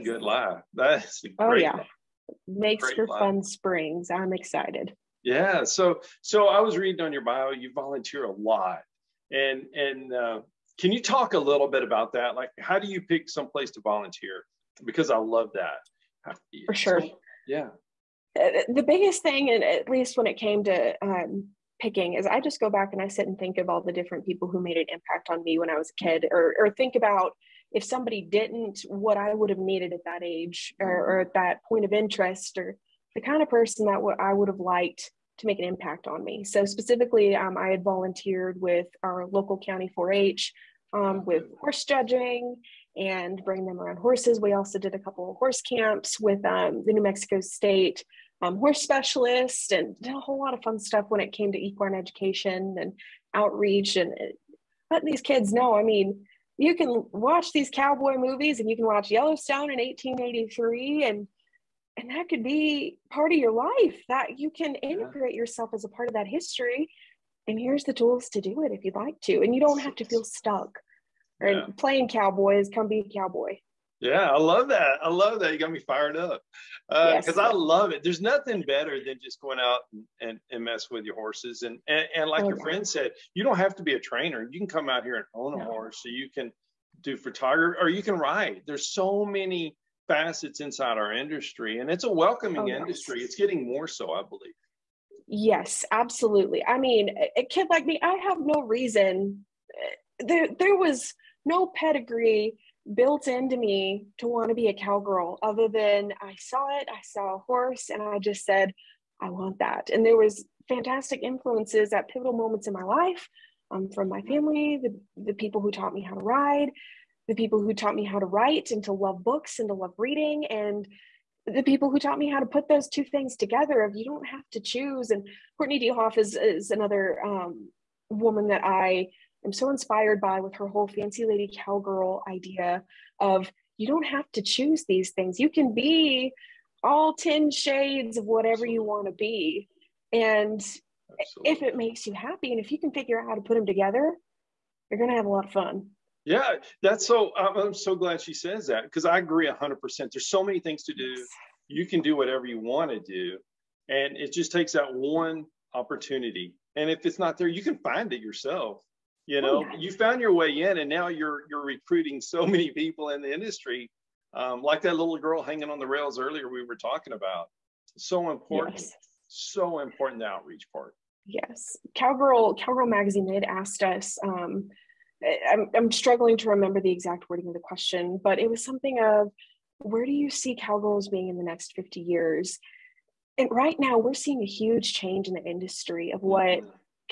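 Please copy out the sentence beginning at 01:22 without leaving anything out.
friend said you don't have to be a trainer you can come out here and own a no.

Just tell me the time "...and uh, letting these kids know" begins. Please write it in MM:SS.
00:53.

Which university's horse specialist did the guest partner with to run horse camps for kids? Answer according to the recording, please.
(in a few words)
New Mexico State.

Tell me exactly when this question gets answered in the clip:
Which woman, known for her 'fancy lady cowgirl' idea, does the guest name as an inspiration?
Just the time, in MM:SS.
02:05.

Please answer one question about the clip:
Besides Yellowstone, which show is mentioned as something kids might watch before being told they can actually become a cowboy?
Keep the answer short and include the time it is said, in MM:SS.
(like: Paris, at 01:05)
1883, at 00:59.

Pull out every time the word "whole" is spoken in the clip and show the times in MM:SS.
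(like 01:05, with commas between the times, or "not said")
00:50, 02:10.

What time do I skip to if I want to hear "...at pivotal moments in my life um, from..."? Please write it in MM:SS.
01:51.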